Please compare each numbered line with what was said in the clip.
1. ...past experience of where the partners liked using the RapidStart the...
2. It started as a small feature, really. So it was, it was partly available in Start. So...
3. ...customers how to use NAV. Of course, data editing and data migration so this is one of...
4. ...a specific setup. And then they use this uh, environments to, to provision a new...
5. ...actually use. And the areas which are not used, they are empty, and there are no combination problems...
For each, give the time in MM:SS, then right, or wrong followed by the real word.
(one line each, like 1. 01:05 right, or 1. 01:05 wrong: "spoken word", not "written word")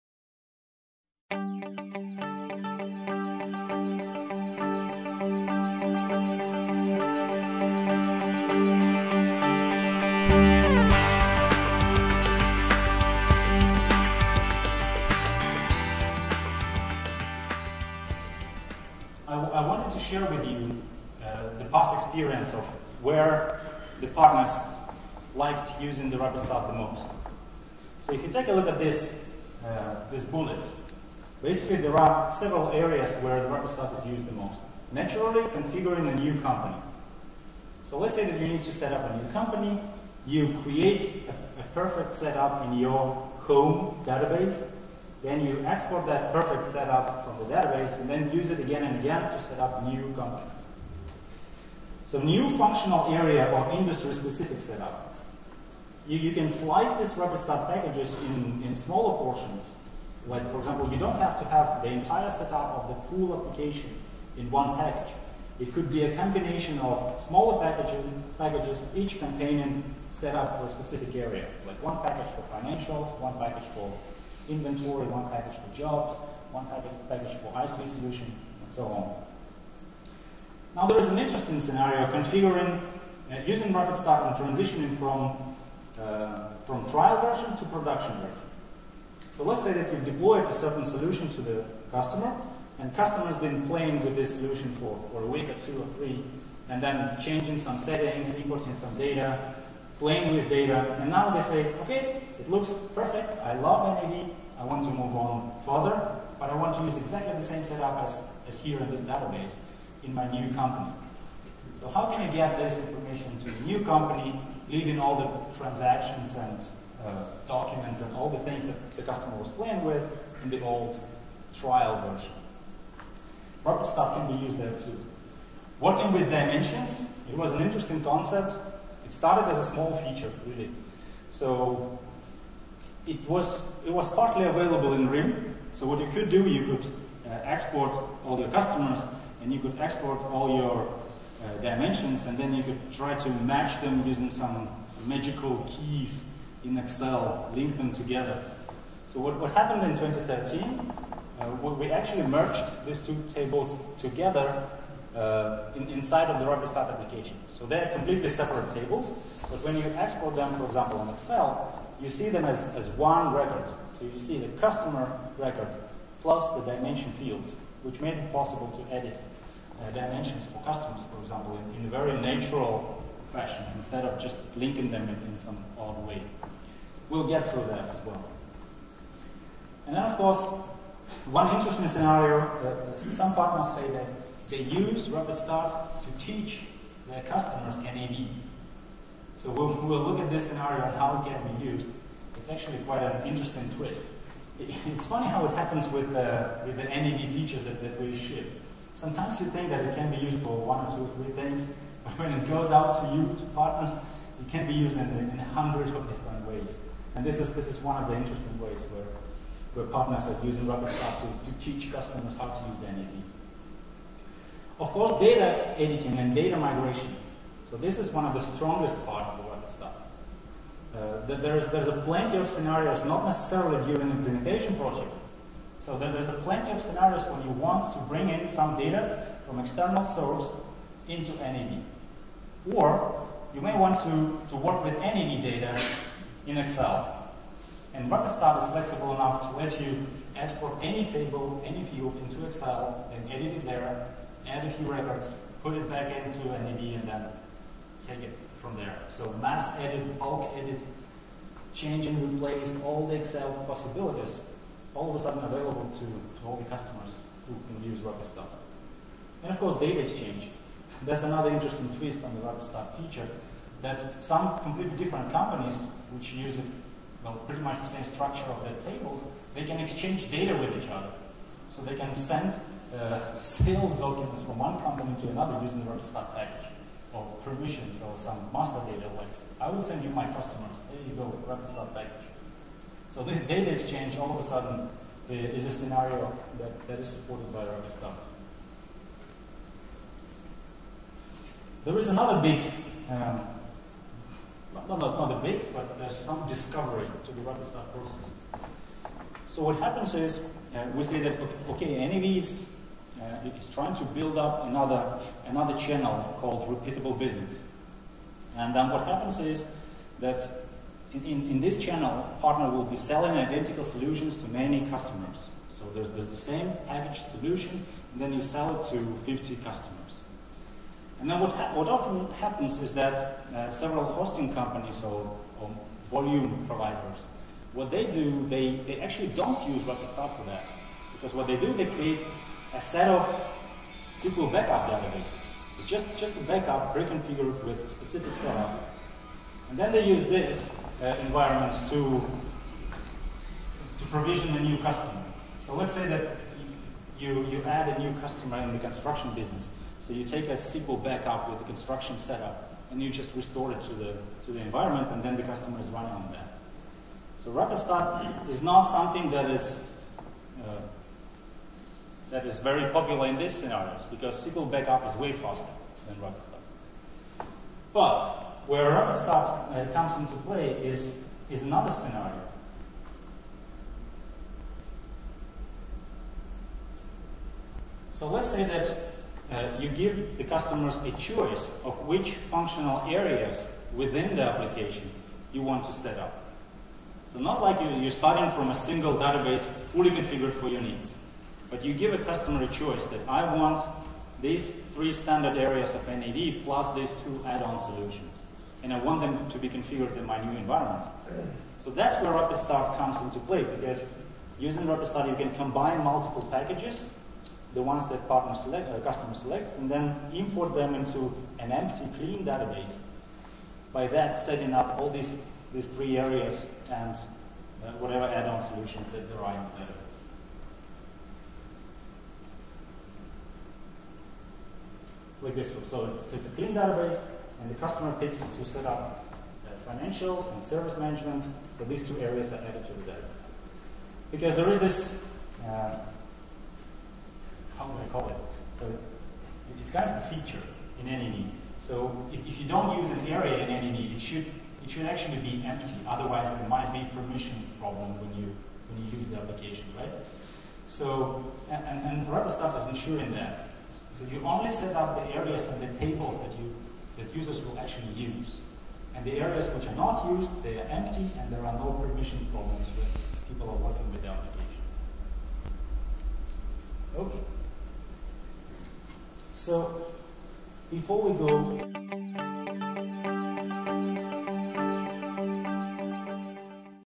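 1. 00:21 right
2. 02:09 wrong: "RIM", not "Start"
3. 03:31 right
4. 05:37 right
5. 07:37 wrong: "permission", not "combination".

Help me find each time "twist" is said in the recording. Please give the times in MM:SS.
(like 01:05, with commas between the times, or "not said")
03:13, 04:21.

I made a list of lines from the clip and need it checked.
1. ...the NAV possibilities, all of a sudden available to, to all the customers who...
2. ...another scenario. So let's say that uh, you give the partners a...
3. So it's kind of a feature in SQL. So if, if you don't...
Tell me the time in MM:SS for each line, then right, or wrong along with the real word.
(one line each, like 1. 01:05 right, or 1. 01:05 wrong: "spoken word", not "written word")
1. 04:13 wrong: "Excel", not "NAV"
2. 06:11 wrong: "customers", not "partners"
3. 07:18 wrong: "NAV", not "SQL".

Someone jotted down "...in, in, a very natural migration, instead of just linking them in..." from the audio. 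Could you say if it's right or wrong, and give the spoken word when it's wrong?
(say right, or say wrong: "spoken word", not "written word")
wrong: "fashion", not "migration".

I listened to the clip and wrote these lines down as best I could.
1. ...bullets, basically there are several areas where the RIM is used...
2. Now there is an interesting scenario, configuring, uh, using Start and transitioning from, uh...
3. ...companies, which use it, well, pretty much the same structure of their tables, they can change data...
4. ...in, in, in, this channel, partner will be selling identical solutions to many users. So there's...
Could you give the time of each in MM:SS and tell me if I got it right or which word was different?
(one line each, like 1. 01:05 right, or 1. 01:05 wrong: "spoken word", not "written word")
1. 00:30 wrong: "RapidStart", not "RIM"
2. 01:20 right
3. 04:25 wrong: "exchange", not "change"
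4. 05:11 wrong: "customers", not "users".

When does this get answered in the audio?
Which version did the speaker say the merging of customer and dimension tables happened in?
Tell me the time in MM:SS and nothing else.
02:29.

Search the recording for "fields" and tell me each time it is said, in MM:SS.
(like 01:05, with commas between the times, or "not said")
02:47, 04:01.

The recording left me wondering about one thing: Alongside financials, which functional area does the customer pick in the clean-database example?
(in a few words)
service management.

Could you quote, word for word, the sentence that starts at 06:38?
And I want them to be configured in my new environment.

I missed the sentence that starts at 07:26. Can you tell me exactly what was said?
Otherwise, there might be permissions problem when you when you use the application, right?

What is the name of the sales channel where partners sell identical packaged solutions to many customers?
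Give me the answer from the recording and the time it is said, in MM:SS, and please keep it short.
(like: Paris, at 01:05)
repeatable business, at 05:06.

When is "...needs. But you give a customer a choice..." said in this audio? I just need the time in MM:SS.
06:30.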